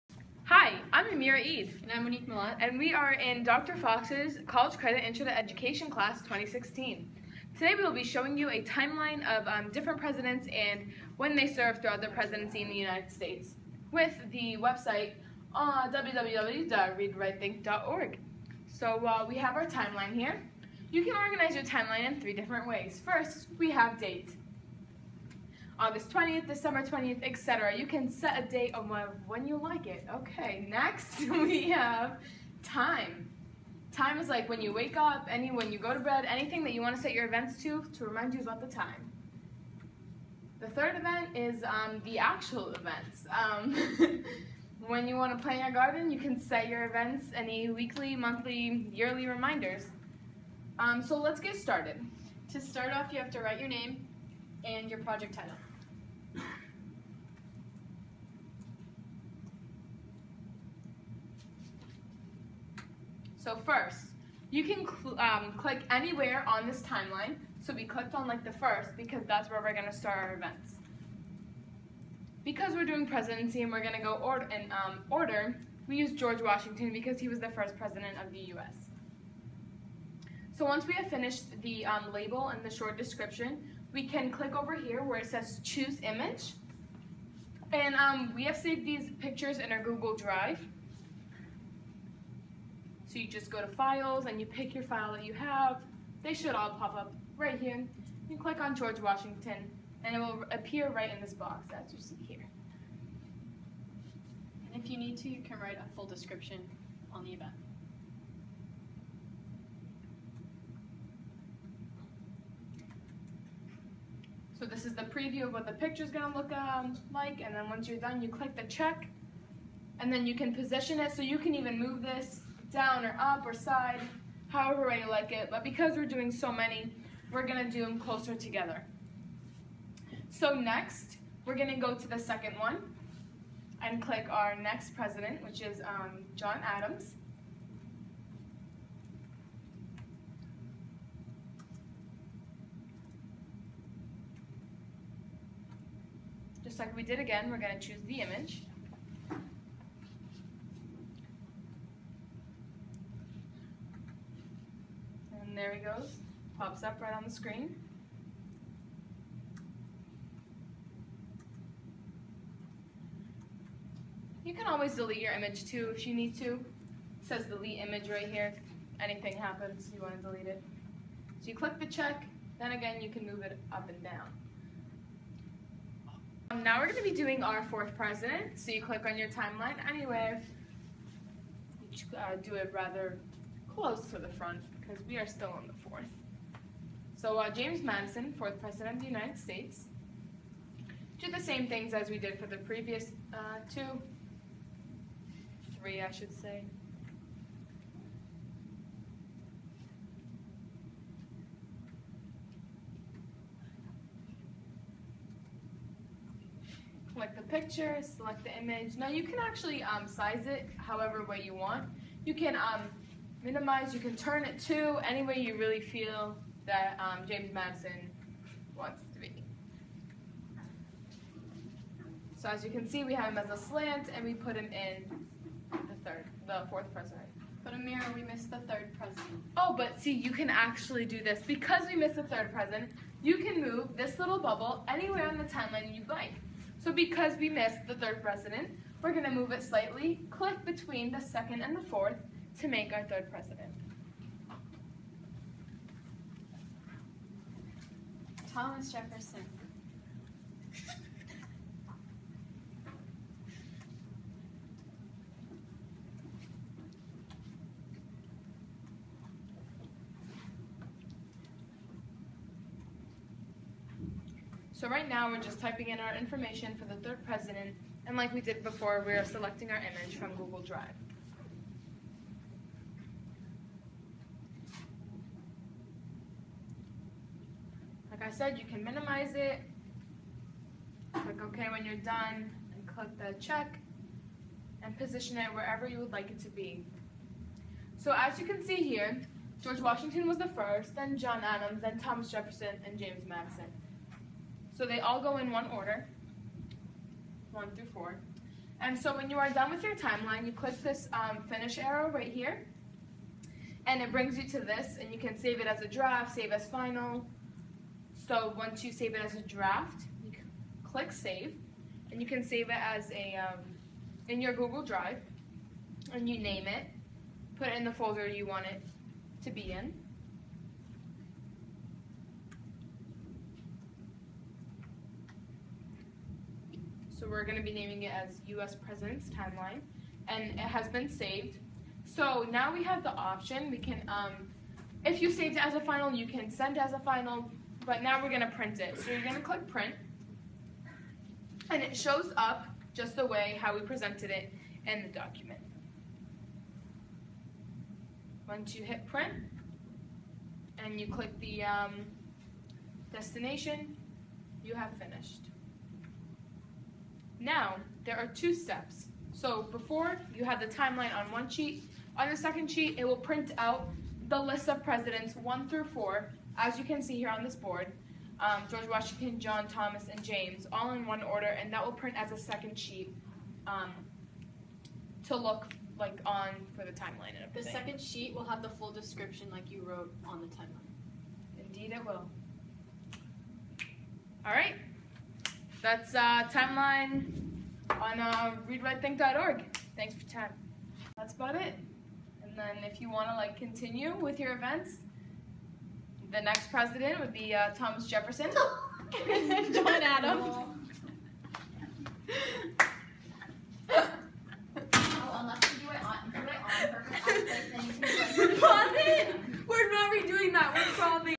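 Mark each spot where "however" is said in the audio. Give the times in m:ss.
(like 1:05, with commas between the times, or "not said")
2:04, 3:30.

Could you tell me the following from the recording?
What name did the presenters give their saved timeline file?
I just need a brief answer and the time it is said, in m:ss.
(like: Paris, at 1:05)
U.S. President's Timeline, at 5:28.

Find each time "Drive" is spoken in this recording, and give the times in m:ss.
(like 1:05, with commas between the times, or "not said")
1:30, 4:30, 5:14.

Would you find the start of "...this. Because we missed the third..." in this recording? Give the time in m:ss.
3:51.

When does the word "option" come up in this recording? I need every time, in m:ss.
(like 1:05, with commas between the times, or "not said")
5:33.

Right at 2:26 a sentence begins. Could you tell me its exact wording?
Just like we did again, we're gonna choose the image.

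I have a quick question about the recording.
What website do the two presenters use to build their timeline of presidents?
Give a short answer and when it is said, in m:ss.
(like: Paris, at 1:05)
readwritethink.org, at 0:15.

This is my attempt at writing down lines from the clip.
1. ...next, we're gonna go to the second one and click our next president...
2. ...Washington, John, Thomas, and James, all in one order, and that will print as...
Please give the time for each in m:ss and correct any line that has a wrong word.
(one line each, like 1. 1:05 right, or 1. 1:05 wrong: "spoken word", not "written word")
1. 2:10 right
2. 6:08 right.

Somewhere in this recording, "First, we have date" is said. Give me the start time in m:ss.
0:23.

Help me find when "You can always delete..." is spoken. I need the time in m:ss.
2:44.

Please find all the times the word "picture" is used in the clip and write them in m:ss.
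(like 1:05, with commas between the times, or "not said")
1:29, 1:55, 3:27.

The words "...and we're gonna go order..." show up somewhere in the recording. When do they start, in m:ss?
1:13.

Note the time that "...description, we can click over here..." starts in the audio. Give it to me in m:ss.
1:22.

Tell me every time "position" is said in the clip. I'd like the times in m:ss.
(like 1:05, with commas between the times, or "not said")
2:00, 4:44.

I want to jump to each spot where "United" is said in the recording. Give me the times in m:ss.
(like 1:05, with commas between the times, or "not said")
0:12, 3:09.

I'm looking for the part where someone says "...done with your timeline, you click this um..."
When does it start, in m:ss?
4:59.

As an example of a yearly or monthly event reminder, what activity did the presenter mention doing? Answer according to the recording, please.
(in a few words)
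Plant your garden.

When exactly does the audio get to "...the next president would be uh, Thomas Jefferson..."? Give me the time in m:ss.
6:36.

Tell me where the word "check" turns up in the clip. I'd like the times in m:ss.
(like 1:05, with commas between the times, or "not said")
1:58, 2:51, 4:43.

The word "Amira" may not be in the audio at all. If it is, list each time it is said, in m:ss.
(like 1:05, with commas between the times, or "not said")
0:01, 3:47.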